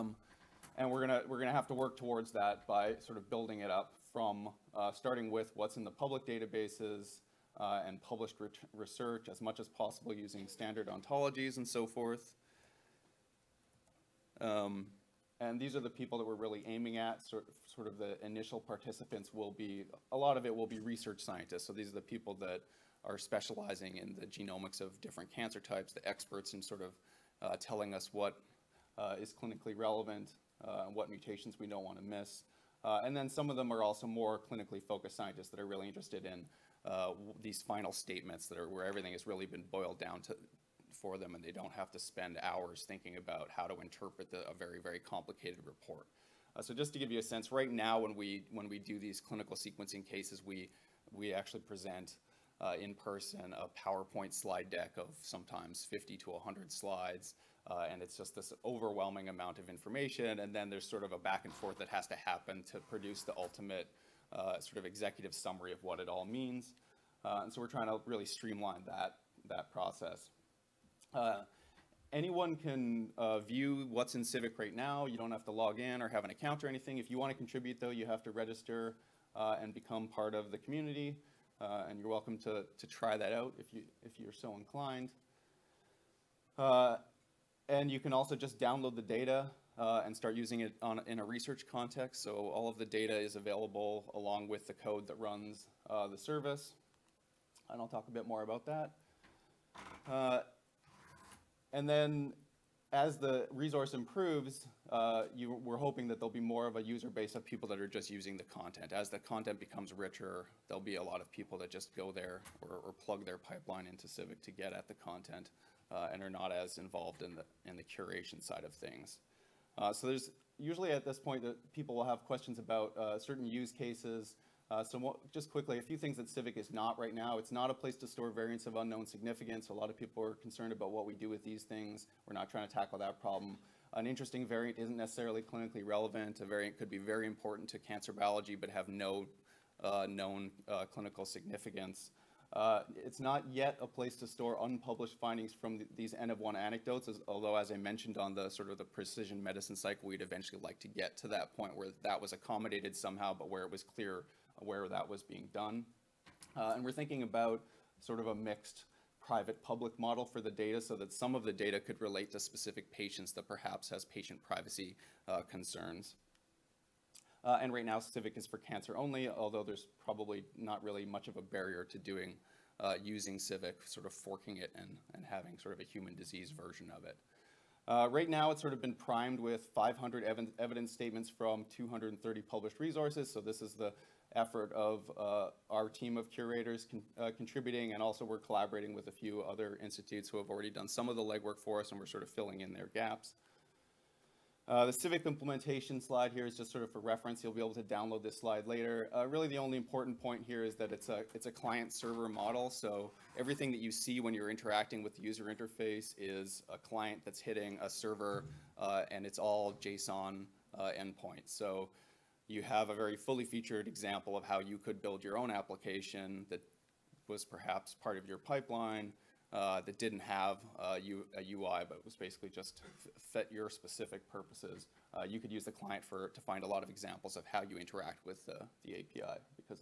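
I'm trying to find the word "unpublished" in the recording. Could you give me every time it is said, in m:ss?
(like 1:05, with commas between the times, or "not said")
2:24.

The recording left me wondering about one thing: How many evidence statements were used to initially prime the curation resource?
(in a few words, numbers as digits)
500.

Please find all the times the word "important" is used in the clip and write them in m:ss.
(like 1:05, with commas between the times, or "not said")
2:17, 3:19.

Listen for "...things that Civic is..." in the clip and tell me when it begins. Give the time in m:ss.
2:05.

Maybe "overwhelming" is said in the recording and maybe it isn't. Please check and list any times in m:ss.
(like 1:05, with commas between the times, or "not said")
0:58.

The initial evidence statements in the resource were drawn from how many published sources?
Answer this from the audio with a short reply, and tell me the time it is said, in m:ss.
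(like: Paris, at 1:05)
230, at 3:01.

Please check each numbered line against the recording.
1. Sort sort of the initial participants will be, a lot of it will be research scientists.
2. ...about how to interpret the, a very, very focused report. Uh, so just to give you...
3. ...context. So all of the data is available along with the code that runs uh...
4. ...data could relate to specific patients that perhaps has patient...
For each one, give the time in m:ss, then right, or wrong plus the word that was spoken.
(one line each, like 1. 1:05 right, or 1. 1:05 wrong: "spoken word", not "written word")
1. 0:17 right
2. 0:43 wrong: "complicated", not "focused"
3. 1:31 right
4. 2:41 right.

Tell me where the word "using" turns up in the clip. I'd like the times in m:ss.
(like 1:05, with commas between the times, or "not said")
0:10, 1:30, 1:48, 2:53.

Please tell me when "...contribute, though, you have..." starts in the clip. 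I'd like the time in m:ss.
1:17.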